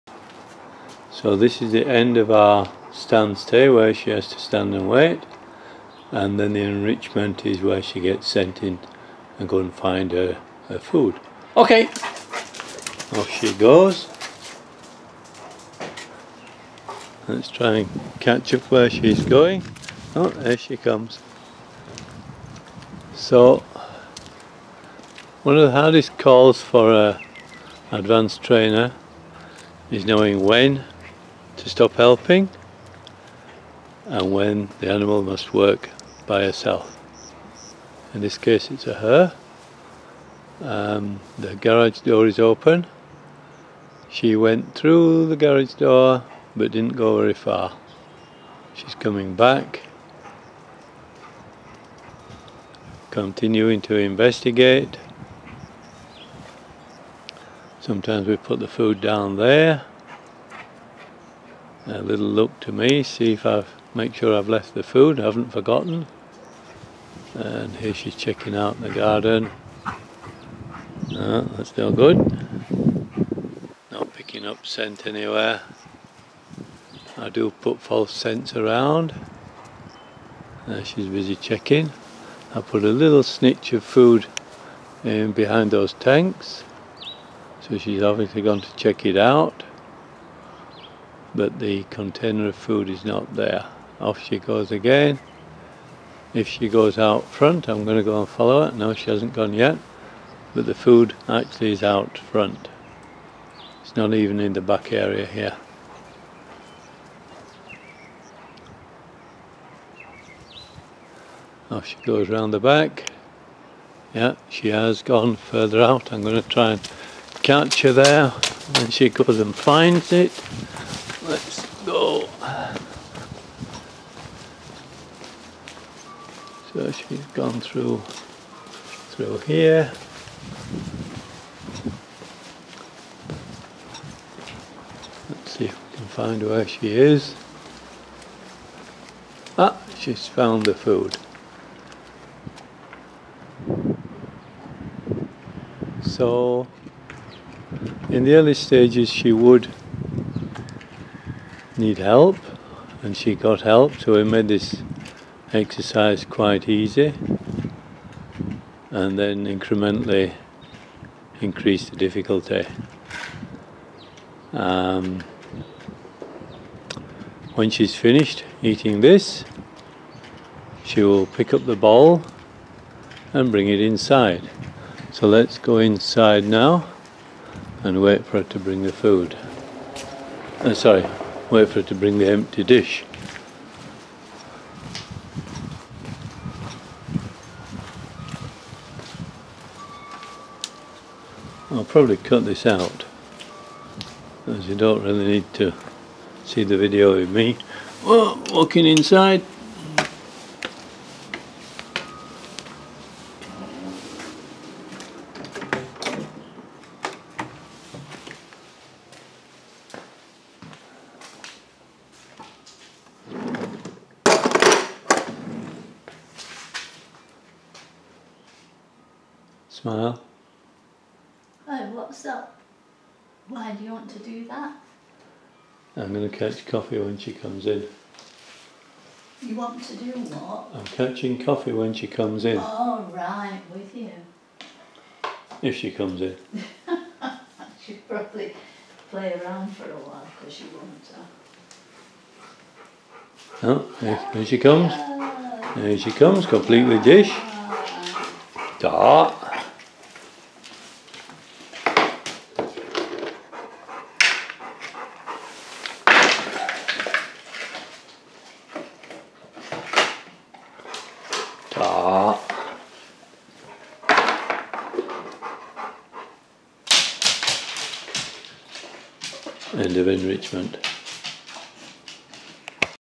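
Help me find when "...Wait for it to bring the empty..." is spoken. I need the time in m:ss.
3:01.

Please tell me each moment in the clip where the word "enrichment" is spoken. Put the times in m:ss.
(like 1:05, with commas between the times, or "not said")
0:06, 4:30.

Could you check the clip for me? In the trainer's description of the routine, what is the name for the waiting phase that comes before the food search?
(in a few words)
Stand stay.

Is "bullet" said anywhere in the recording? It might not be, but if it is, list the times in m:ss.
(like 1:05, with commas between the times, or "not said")
not said.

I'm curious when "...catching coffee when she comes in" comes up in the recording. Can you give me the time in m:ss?
3:50.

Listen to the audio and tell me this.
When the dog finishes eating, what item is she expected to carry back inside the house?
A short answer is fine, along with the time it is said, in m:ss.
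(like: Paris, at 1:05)
The bowl, at 2:51.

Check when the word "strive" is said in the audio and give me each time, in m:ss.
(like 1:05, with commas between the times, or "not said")
not said.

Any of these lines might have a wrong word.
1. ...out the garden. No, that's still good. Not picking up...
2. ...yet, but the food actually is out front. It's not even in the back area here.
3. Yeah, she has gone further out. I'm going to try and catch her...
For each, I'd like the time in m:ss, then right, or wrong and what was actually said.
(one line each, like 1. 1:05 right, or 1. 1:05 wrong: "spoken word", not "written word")
1. 1:08 right
2. 1:39 right
3. 1:54 right.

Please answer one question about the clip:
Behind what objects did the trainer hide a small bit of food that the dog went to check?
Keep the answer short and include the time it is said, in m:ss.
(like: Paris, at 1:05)
Tanks, at 1:25.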